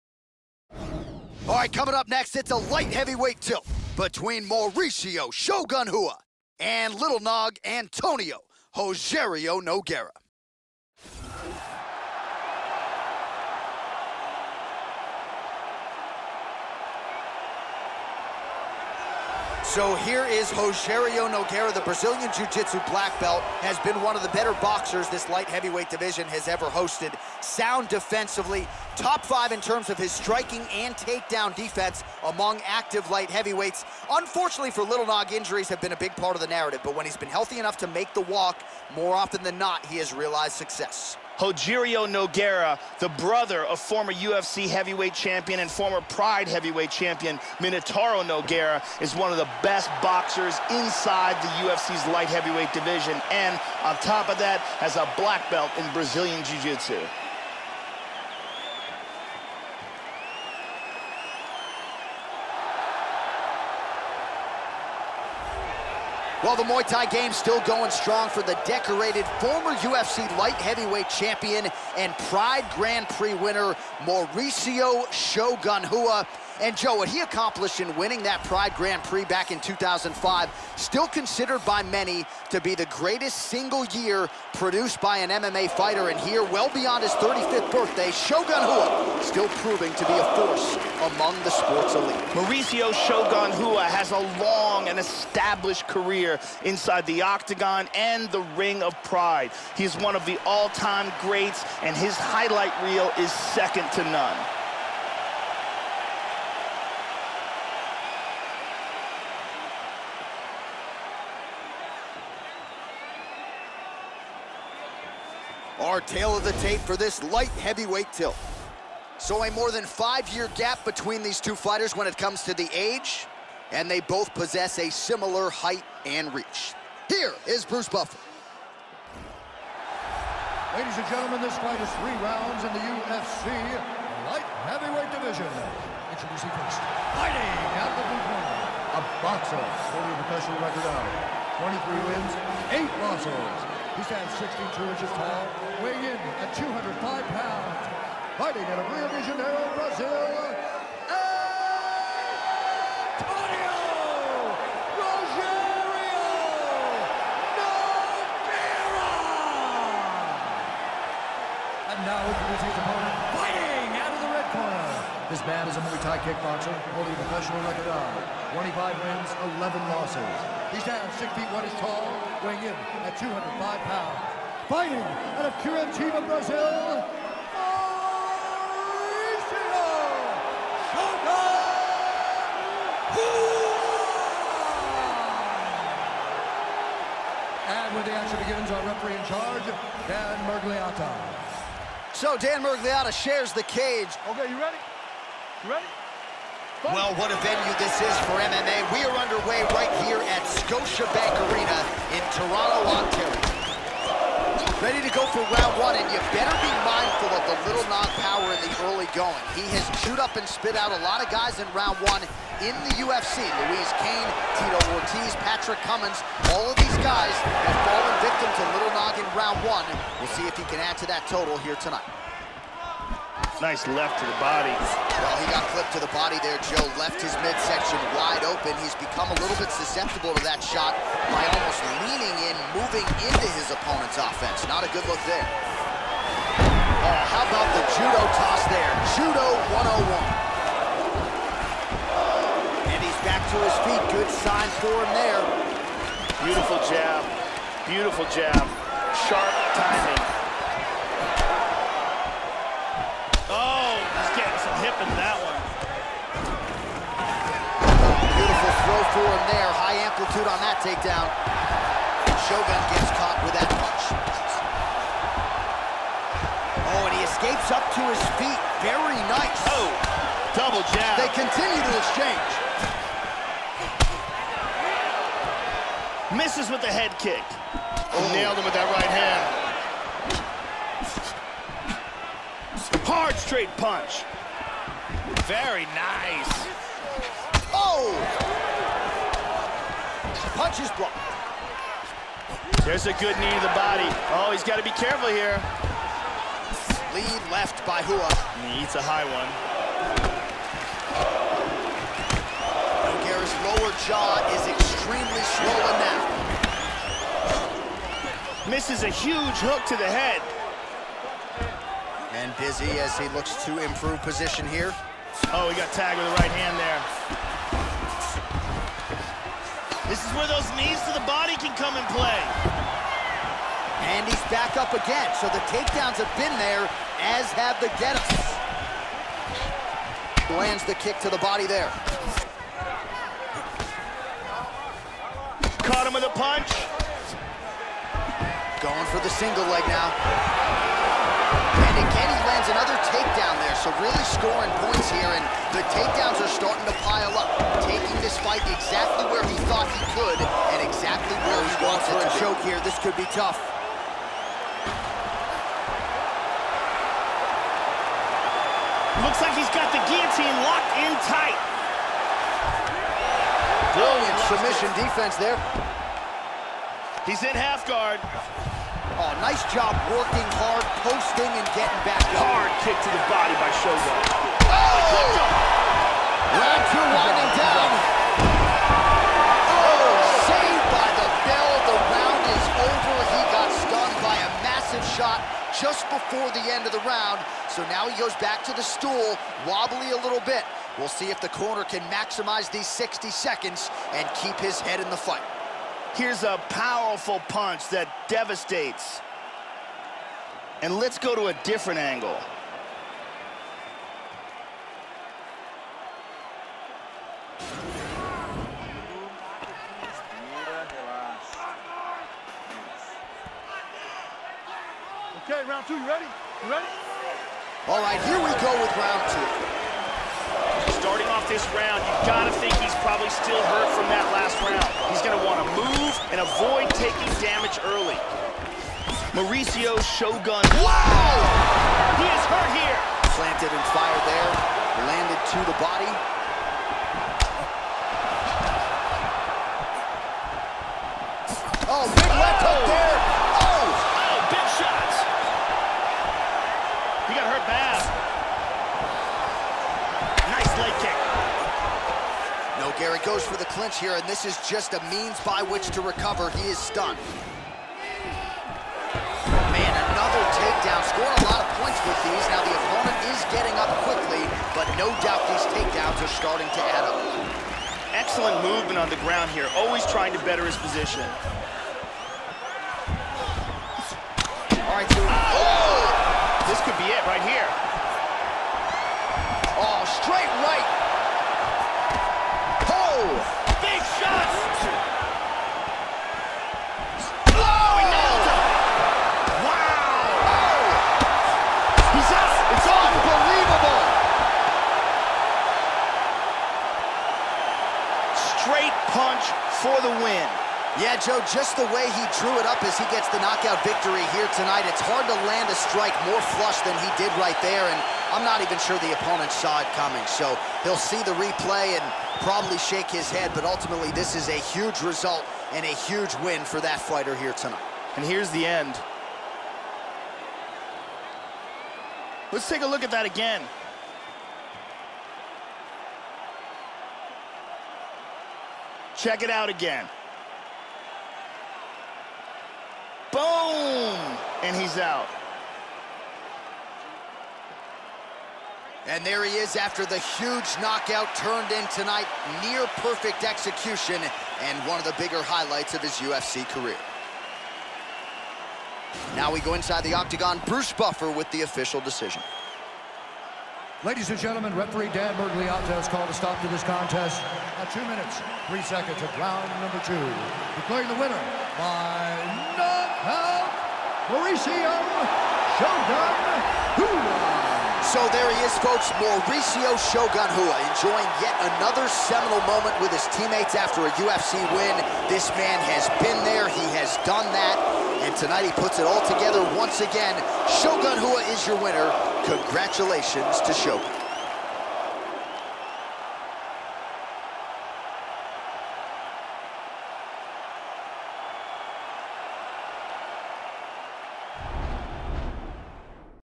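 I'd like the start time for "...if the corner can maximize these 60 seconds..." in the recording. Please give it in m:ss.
6:31.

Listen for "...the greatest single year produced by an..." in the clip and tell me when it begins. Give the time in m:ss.
1:22.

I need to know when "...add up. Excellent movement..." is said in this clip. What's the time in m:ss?
7:46.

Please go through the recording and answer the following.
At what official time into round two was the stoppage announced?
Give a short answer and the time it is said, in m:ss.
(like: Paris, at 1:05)
2:03, at 9:17.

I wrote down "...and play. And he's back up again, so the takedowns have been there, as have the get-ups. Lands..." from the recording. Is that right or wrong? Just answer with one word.
right.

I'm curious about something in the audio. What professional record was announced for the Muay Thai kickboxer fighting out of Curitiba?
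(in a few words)
25 wins, 11 losses.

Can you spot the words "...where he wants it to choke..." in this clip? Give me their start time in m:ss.
5:51.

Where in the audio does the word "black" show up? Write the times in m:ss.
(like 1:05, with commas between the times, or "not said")
0:22, 0:55.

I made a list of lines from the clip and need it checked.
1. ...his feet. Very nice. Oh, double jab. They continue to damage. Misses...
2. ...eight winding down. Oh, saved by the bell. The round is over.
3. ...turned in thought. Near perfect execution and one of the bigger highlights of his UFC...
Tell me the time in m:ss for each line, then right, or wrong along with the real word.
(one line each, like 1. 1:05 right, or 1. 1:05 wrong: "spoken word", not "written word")
1. 4:28 wrong: "exchange", not "damage"
2. 6:16 wrong: "two", not "eight"
3. 9:01 wrong: "tonight", not "thought".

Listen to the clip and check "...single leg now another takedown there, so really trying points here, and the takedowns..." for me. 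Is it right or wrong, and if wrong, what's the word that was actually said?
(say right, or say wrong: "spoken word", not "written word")
wrong: "scoring", not "trying".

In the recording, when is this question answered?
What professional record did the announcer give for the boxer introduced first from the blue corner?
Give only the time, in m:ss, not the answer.
2:21.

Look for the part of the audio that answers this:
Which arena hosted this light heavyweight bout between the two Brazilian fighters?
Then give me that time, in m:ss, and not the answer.
3:20.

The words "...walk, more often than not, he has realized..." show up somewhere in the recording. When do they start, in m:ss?
0:38.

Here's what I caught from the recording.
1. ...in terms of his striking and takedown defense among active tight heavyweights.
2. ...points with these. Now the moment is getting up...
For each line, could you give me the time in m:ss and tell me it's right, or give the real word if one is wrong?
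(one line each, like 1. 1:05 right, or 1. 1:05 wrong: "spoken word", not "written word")
1. 0:29 wrong: "light", not "tight"
2. 7:41 wrong: "opponent", not "moment".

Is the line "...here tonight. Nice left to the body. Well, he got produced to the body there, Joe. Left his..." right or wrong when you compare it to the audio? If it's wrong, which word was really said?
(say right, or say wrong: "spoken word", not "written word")
wrong: "clipped", not "produced".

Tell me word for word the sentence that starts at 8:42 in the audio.
Let's take a look at that again.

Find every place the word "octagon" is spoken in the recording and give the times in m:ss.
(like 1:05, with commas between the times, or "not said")
1:37, 9:10.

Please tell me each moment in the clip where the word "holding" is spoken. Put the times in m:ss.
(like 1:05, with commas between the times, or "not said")
2:19, 2:46.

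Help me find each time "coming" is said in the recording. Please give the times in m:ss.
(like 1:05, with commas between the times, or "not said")
0:01, 8:29.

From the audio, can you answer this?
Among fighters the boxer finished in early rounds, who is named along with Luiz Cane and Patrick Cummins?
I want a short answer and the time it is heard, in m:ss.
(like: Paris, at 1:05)
Tito Ortiz, at 3:34.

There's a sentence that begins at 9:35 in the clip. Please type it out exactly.
This man has been there, he has done that, and tonight he puts it all together once again.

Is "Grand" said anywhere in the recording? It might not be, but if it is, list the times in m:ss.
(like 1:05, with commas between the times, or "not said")
1:12, 1:18.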